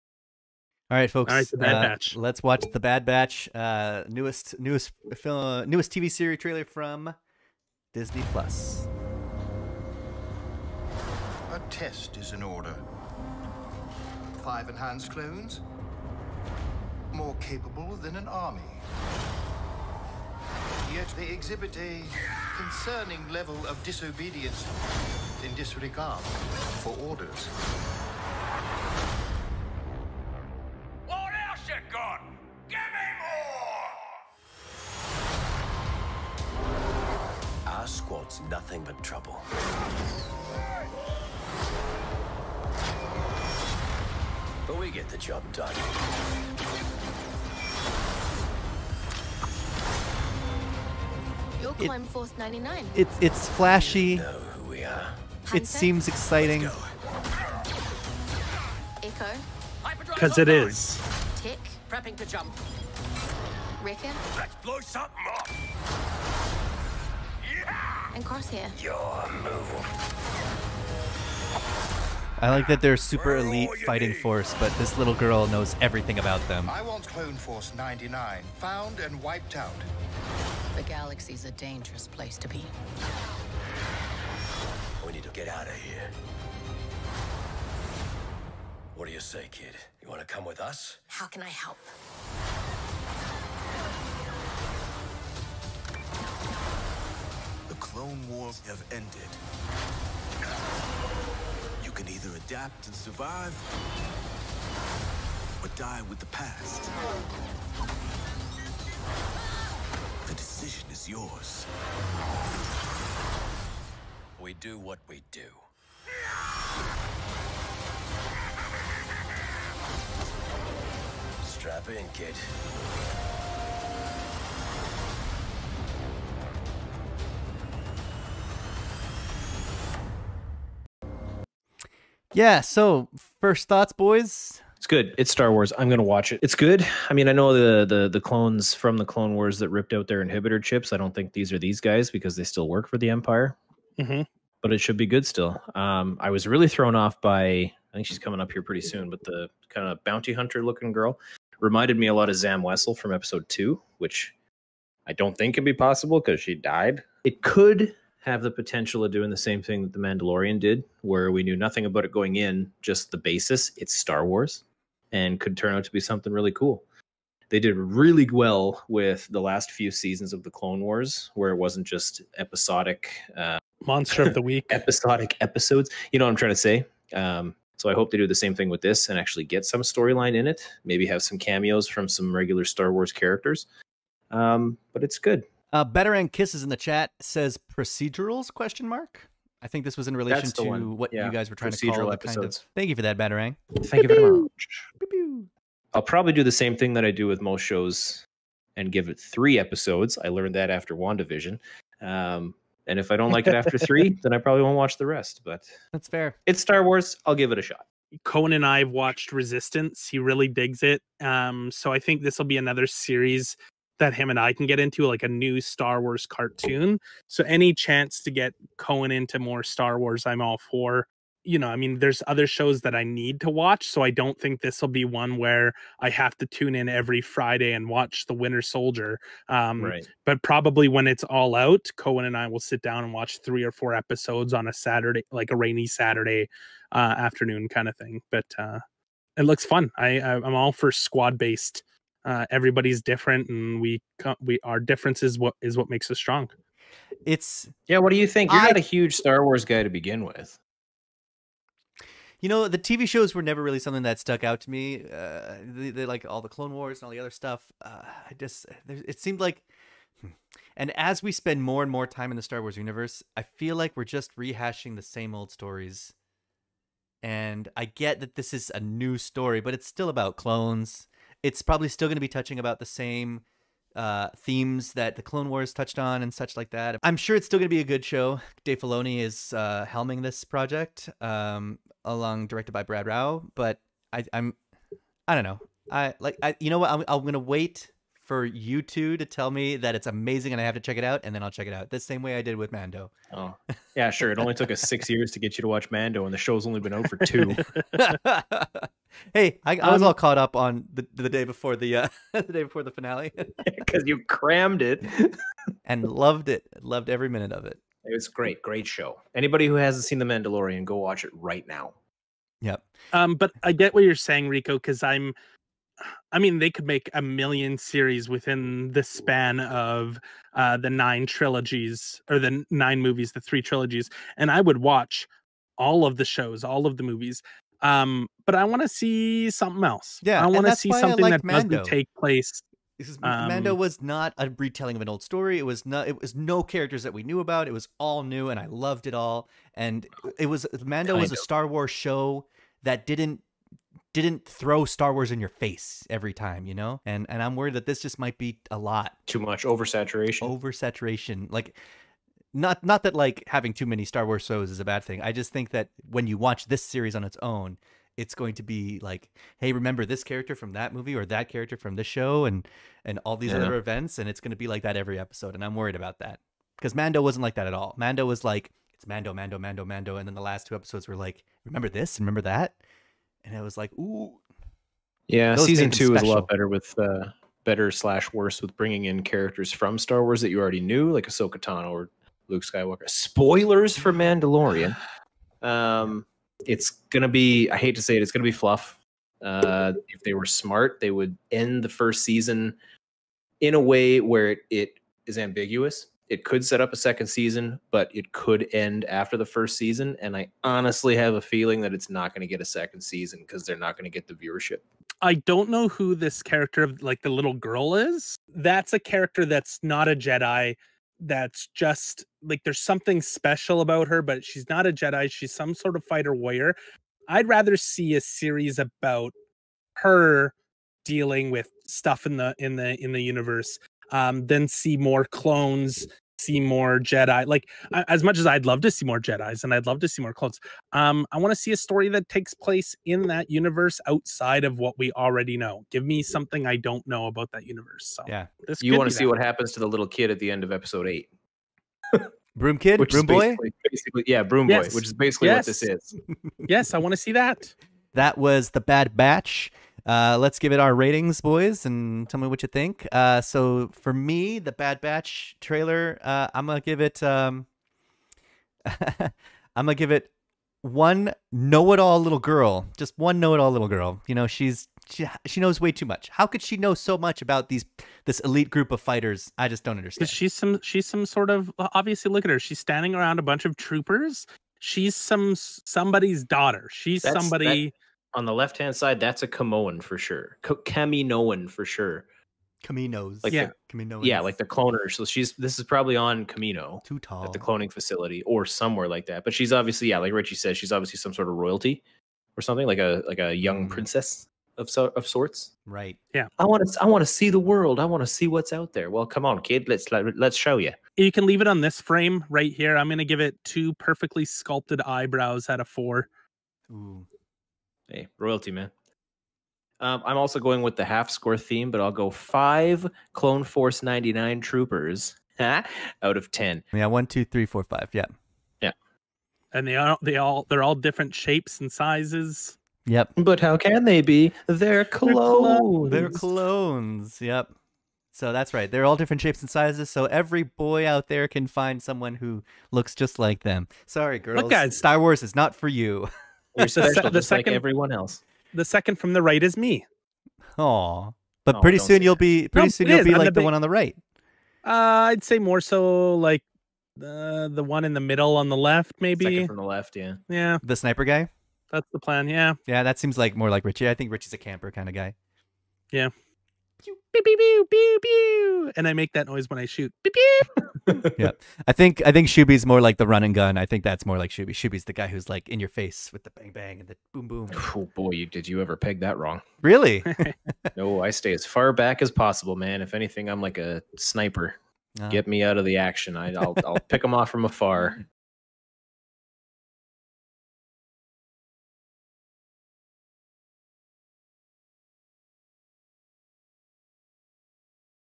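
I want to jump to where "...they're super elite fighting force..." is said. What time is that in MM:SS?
01:12.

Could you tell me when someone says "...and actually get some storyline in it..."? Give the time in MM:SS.
02:59.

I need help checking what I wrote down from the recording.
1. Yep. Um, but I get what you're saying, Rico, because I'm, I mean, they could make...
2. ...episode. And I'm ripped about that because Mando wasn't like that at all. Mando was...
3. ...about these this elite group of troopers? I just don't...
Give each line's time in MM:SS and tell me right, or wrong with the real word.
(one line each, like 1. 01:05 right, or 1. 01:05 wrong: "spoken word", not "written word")
1. 05:12 right
2. 06:05 wrong: "worried", not "ripped"
3. 07:47 wrong: "fighters", not "troopers".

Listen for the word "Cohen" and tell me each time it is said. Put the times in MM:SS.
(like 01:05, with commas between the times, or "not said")
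03:28, 03:38, 03:51.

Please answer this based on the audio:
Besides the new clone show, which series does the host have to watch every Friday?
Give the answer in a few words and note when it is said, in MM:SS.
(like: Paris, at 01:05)
The Winter Soldier, at 03:48.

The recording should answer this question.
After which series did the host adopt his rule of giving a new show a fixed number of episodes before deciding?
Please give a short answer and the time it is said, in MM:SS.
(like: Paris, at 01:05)
WandaVision, at 03:20.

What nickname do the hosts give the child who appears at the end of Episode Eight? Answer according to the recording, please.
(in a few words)
Broom Boy.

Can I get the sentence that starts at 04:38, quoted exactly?
Dave Filoni is uh, helming this project, um, along directed by Brad Rau.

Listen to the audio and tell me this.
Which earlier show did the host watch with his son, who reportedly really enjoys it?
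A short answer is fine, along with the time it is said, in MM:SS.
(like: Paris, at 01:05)
Resistance, at 03:29.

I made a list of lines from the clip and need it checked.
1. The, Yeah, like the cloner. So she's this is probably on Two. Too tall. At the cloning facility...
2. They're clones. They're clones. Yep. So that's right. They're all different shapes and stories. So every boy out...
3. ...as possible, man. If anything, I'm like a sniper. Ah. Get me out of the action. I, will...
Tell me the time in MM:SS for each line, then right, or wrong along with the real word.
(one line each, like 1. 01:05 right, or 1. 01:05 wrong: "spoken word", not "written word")
1. 08:03 wrong: "Kamino", not "Two"
2. 08:44 wrong: "sizes", not "stories"
3. 09:32 right.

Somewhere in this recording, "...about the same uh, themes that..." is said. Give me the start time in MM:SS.
04:32.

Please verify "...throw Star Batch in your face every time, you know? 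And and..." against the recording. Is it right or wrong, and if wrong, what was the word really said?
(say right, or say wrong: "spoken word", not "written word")
wrong: "Wars", not "Batch".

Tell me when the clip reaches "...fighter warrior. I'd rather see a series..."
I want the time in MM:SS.
06:56.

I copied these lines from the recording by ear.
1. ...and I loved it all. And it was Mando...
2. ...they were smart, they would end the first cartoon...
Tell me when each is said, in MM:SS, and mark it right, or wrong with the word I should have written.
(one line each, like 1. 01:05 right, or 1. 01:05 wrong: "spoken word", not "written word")
1. 05:38 right
2. 06:30 wrong: "season", not "cartoon".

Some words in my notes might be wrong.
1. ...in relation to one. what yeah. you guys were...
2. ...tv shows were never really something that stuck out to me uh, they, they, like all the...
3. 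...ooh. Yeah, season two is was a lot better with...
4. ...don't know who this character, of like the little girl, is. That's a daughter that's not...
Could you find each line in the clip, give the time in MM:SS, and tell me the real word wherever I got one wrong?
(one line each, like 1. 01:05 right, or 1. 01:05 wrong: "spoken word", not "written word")
1. 03:10 right
2. 04:12 right
3. 06:13 right
4. 06:45 wrong: "character", not "daughter".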